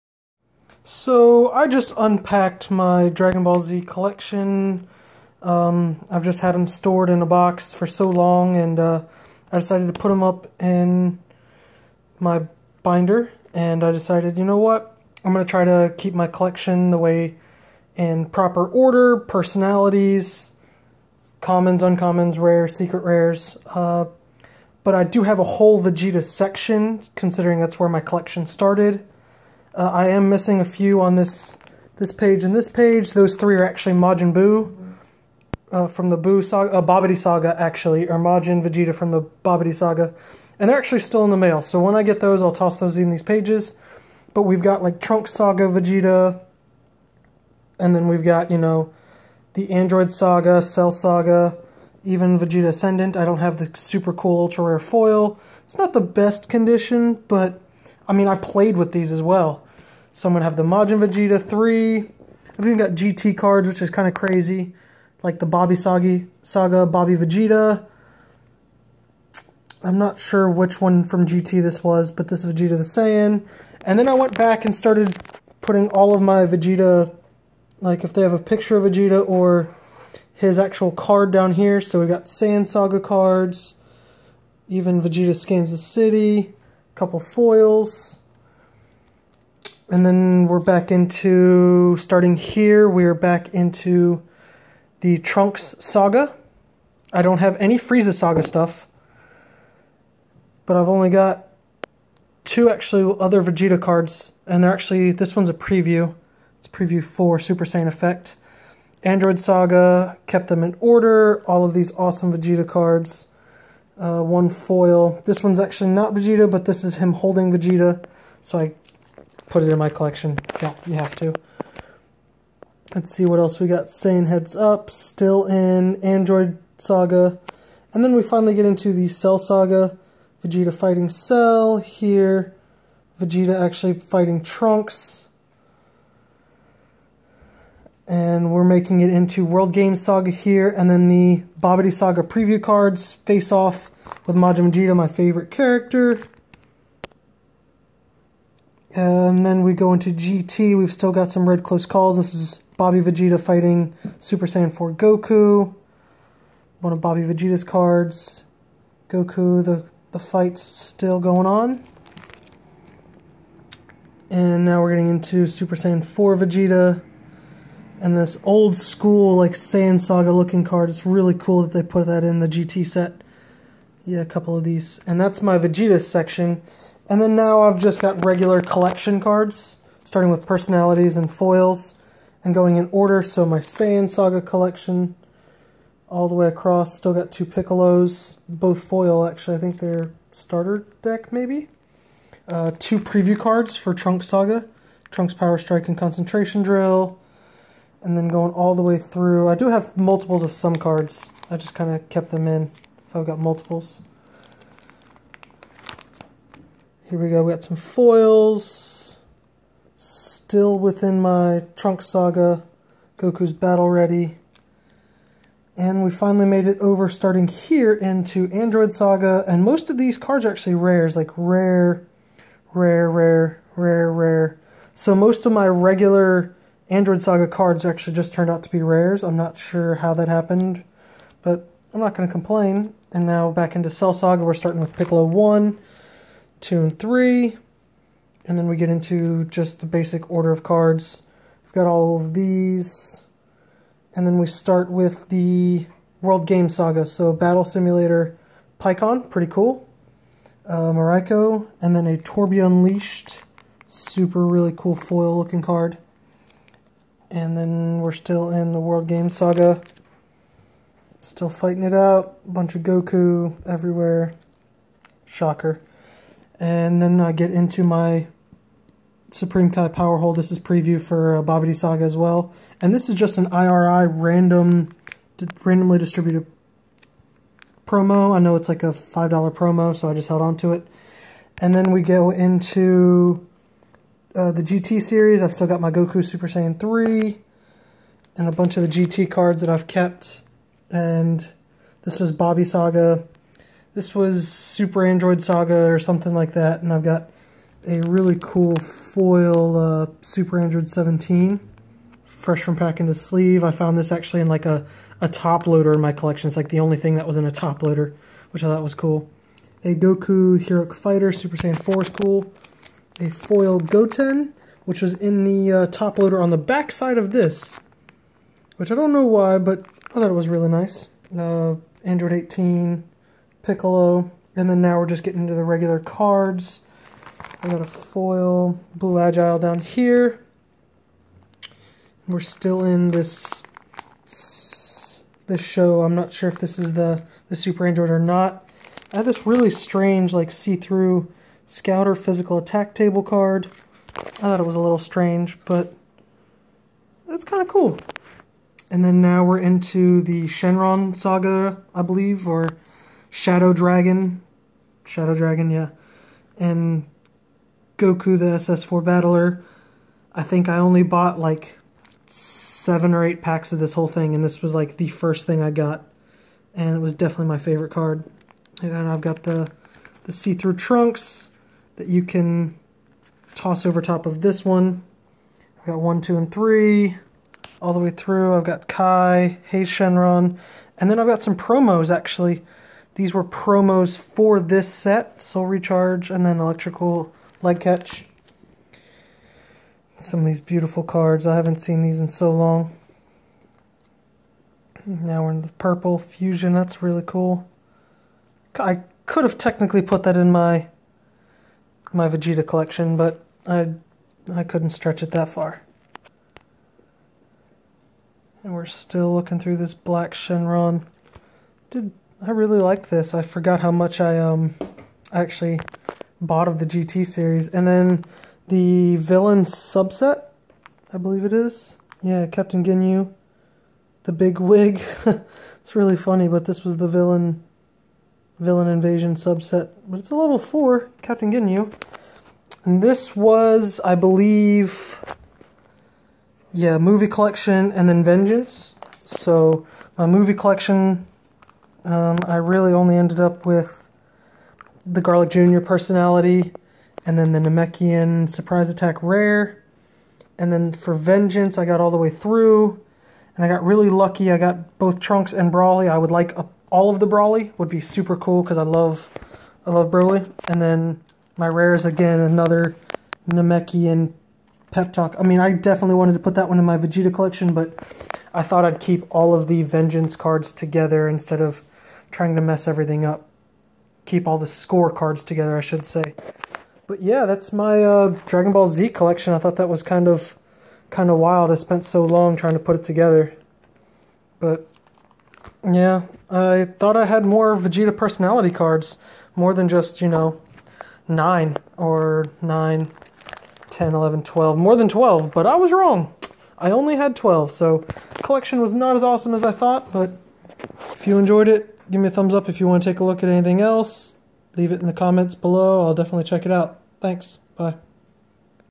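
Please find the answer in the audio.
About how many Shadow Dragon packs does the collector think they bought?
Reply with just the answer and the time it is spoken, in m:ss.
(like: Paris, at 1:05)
7 or 8, at 6:02.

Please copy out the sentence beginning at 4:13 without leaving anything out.
Super really cool foil looking card.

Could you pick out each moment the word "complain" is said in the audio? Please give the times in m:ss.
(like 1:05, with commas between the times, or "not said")
3:52.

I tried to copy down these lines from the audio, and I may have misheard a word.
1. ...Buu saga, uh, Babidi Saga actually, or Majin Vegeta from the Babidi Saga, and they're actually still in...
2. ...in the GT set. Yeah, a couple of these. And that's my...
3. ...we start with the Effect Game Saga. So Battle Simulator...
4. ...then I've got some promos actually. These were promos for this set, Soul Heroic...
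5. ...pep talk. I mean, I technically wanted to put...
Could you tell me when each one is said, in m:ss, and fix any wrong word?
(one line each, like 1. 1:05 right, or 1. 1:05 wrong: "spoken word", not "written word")
1. 0:36 right
2. 2:52 right
3. 4:04 wrong: "World", not "Effect"
4. 6:21 wrong: "Recharge", not "Heroic"
5. 7:44 wrong: "definitely", not "technically".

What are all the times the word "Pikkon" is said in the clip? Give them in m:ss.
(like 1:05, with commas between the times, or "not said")
4:08.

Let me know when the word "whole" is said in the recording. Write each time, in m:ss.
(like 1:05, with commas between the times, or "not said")
0:25, 6:03.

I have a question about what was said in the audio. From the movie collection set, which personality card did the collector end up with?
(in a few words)
Garlic Jr.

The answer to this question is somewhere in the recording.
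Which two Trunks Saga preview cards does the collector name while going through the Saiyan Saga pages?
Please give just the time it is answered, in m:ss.
3:15.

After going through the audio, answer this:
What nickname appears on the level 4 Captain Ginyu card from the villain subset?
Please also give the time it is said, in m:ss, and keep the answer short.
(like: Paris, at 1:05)
The big wig, at 7:04.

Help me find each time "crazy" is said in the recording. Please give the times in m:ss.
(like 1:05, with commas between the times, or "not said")
1:04.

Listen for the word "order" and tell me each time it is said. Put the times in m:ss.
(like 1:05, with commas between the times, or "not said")
0:18, 1:50, 3:02, 4:00.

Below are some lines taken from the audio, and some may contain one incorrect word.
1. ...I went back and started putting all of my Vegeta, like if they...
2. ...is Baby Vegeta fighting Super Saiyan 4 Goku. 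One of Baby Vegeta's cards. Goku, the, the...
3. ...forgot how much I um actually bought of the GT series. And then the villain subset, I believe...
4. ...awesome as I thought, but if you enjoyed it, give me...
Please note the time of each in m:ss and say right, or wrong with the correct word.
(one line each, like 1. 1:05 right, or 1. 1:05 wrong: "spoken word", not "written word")
1. 1:14 right
2. 2:32 right
3. 6:53 right
4. 8:19 right.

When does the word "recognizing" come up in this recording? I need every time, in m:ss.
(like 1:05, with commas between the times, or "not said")
not said.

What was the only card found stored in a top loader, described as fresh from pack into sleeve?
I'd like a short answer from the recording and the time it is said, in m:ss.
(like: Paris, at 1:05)
Super Android 17, at 5:00.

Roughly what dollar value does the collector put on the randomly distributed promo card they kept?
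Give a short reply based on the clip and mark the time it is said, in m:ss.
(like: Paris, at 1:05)
$5, at 4:38.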